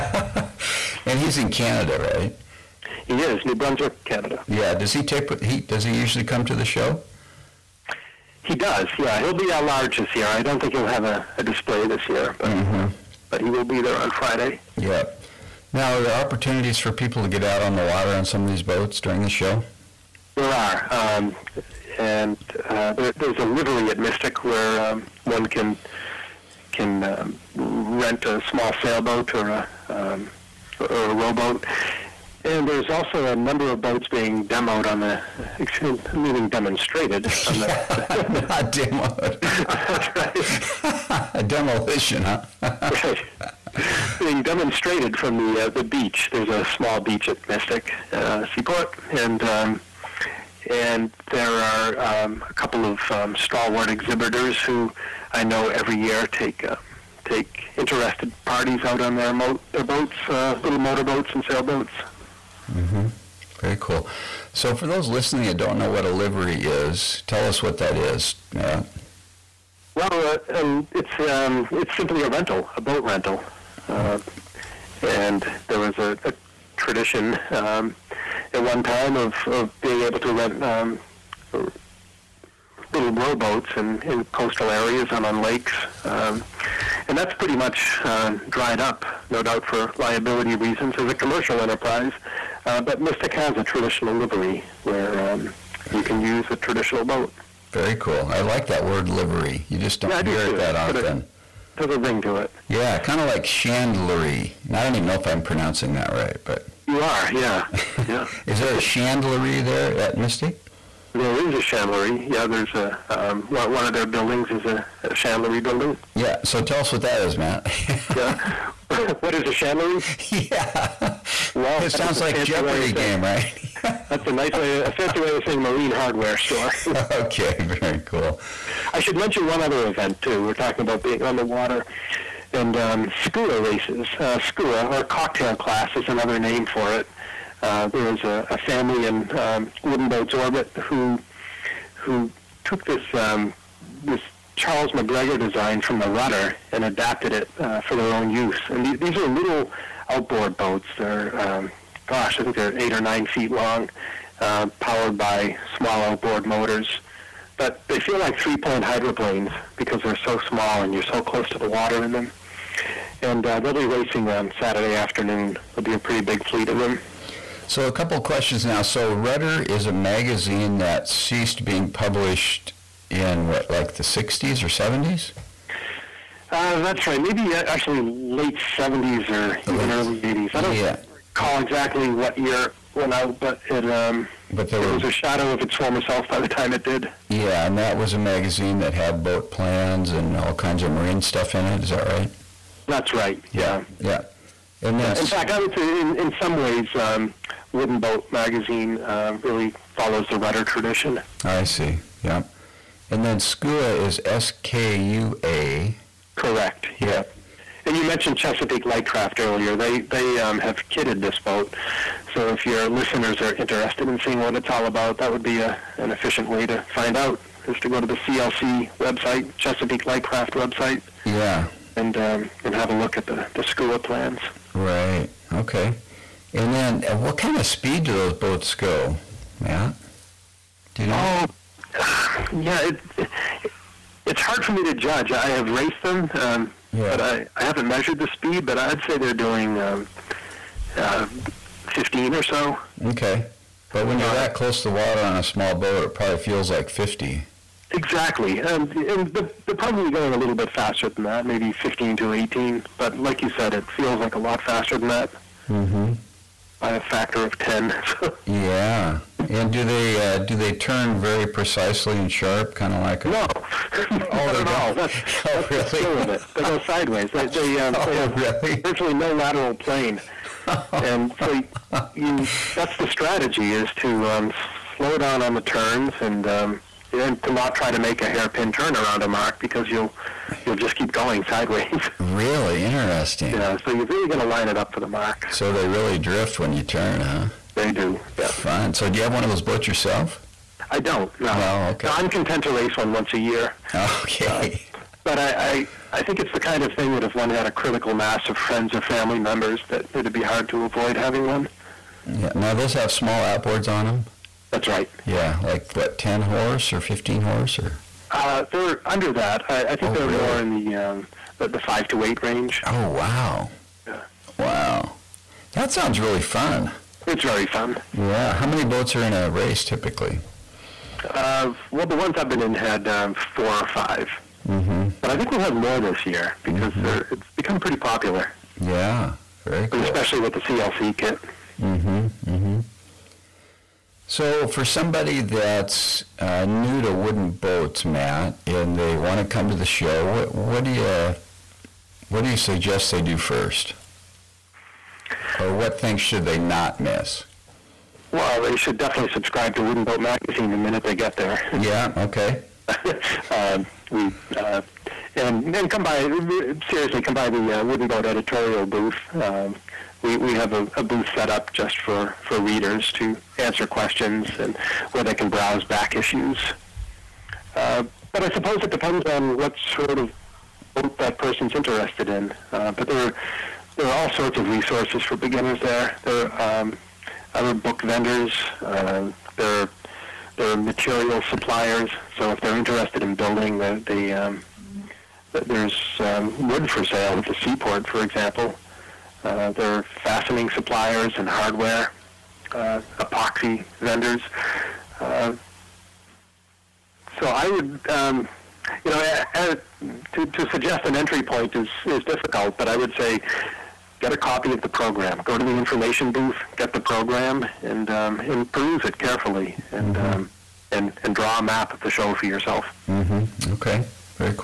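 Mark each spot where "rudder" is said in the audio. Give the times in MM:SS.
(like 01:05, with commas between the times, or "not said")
02:26, 02:49, 03:20.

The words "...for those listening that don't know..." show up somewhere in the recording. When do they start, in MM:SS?
01:04.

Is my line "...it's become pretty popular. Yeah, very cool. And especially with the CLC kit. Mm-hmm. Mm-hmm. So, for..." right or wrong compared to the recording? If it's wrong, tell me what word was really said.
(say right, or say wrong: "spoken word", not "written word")
right.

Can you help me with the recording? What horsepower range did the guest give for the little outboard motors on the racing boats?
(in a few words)
5 to 8.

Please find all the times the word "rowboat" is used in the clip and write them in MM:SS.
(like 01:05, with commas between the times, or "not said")
00:31, 01:23.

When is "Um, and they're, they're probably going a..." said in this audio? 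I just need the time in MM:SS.
04:08.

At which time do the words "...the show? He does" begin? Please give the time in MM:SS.
00:06.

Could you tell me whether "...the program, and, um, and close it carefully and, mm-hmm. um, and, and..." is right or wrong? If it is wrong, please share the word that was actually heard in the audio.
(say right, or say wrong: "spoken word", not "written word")
wrong: "peruse", not "close".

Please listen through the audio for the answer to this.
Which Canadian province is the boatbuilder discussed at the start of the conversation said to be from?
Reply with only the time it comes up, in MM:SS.
00:03.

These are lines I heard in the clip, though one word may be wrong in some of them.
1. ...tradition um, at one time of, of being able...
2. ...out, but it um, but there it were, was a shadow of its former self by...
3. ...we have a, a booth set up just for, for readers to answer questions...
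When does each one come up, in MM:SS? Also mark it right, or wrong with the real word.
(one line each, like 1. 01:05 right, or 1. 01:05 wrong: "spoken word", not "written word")
1. 01:16 right
2. 03:03 right
3. 06:00 right.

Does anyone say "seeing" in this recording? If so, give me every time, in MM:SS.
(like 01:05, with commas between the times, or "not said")
03:34.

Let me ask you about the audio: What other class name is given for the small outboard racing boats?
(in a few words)
cocktail class.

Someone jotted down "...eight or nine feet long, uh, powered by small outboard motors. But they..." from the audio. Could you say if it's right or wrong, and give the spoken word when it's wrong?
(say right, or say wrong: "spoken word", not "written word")
right.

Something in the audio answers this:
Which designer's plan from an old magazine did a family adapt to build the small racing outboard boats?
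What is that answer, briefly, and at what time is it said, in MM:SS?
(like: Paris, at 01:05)
Charles McGregor, at 02:24.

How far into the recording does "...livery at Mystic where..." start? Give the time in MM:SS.
00:23.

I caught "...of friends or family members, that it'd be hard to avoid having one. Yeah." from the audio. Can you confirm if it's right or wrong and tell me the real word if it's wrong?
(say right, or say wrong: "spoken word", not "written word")
right.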